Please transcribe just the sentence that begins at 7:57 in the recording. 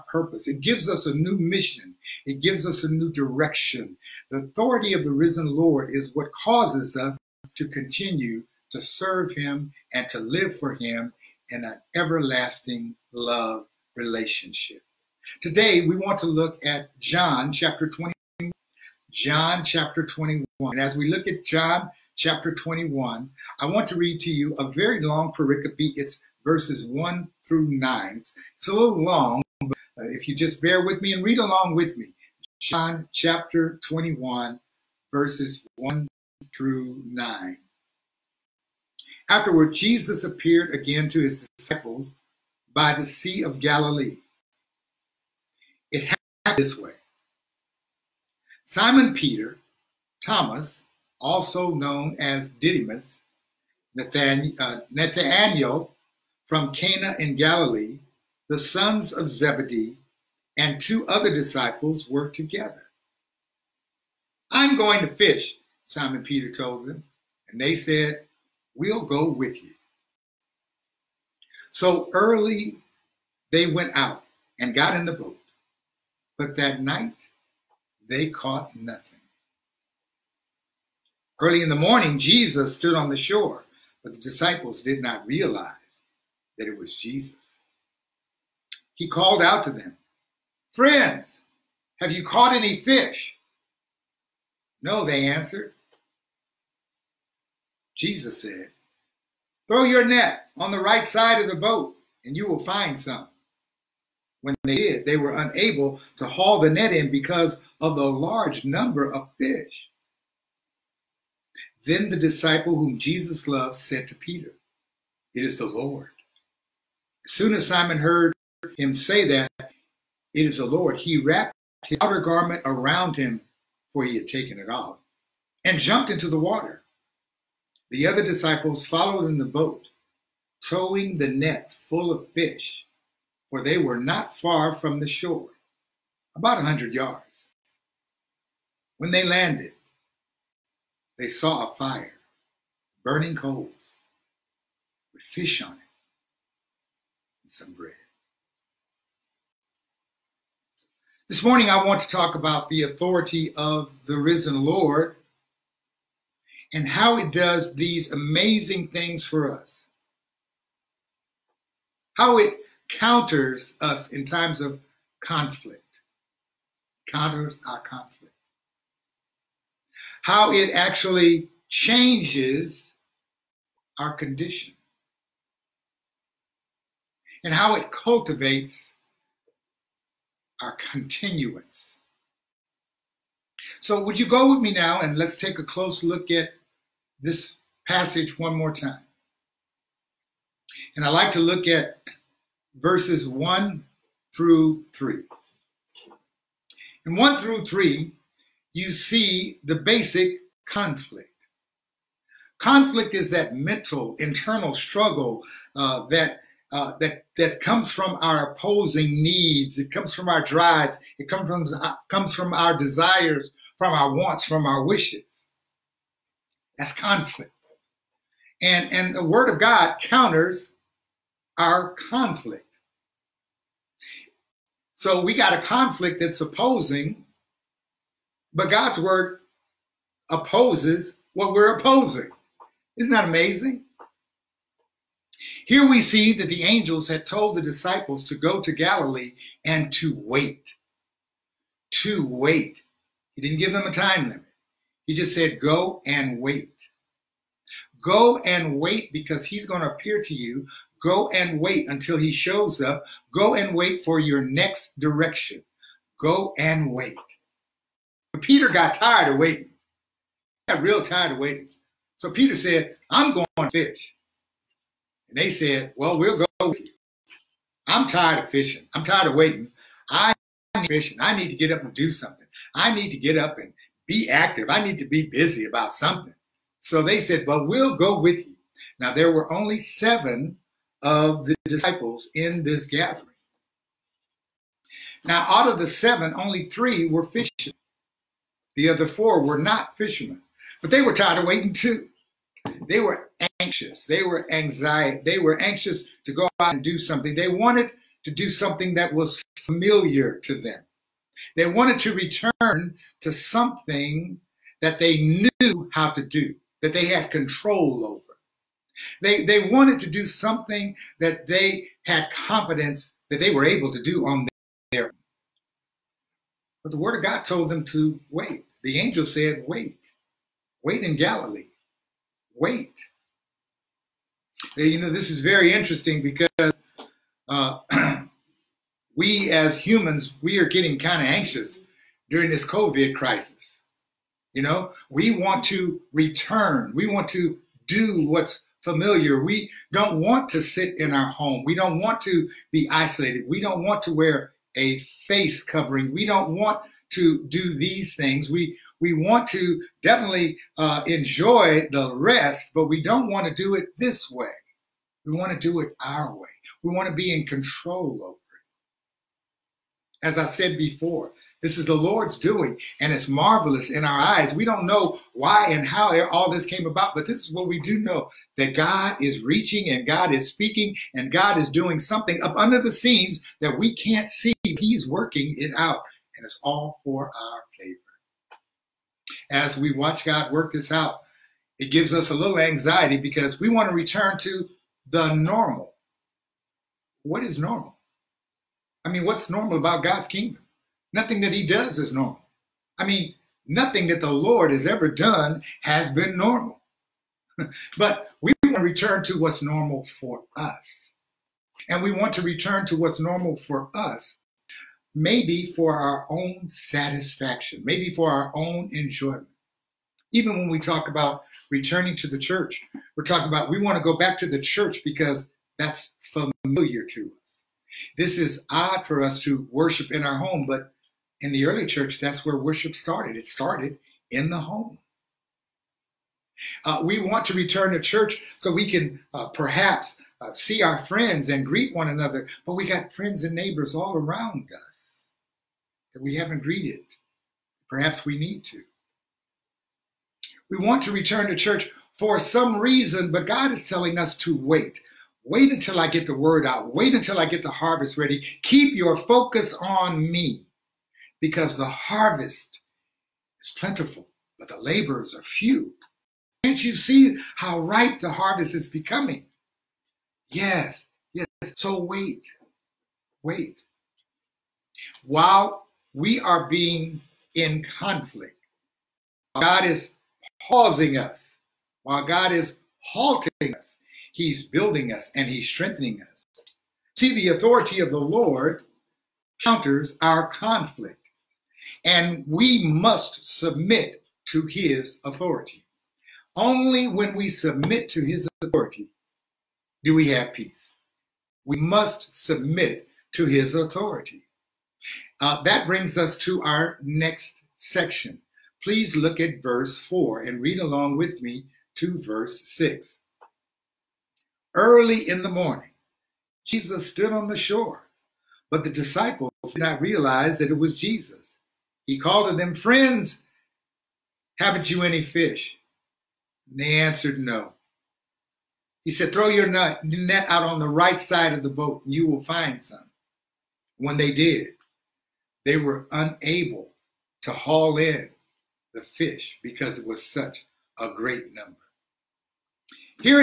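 See, the authority of the Lord counters our conflict, and we must submit to his authority.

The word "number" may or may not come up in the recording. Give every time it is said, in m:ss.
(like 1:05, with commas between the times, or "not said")
1:48, 8:51.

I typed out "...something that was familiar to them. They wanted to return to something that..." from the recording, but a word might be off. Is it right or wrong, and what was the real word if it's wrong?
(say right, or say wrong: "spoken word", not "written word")
right.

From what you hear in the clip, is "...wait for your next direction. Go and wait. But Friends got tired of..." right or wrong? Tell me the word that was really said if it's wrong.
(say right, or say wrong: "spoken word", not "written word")
wrong: "Peter", not "Friends".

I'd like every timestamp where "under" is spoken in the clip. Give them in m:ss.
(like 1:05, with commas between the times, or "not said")
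6:12.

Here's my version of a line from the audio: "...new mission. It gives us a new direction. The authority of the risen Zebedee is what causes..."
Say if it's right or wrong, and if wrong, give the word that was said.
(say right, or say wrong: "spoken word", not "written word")
wrong: "Lord", not "Zebedee".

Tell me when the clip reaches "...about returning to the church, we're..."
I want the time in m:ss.
6:51.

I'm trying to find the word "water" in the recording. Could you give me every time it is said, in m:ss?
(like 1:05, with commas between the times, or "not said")
2:06.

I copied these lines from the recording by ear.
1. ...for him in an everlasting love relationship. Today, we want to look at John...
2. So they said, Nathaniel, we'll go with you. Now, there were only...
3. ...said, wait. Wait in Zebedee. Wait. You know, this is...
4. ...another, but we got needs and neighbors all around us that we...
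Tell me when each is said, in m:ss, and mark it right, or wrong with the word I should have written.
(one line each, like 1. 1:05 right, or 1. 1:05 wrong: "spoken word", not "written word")
1. 0:10 right
2. 4:36 wrong: "Well", not "Nathaniel"
3. 5:19 wrong: "Galilee", not "Zebedee"
4. 7:12 wrong: "friends", not "needs".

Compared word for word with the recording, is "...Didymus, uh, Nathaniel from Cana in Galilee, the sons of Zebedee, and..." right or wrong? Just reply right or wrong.
right.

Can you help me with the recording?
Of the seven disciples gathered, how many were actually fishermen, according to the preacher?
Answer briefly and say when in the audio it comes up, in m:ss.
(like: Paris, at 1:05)
3, at 4:46.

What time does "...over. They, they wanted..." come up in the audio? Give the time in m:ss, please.
5:08.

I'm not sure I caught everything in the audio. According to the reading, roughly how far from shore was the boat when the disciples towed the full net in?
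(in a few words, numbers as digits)
about 100 yards.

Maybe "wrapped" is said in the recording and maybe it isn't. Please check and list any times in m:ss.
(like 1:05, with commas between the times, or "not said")
2:01.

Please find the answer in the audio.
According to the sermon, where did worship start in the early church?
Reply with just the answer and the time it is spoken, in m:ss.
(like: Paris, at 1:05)
in the home, at 7:03.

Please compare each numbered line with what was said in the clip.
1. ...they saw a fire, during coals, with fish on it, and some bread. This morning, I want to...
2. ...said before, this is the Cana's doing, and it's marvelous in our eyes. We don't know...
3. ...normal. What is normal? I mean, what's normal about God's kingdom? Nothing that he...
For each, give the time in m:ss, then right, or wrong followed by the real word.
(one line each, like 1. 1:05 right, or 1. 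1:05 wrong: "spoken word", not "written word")
1. 2:21 wrong: "burning", not "during"
2. 6:00 wrong: "Lord", not "Cana"
3. 6:25 right.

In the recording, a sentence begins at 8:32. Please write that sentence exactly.
He called to them, Friends, haven't you any fish?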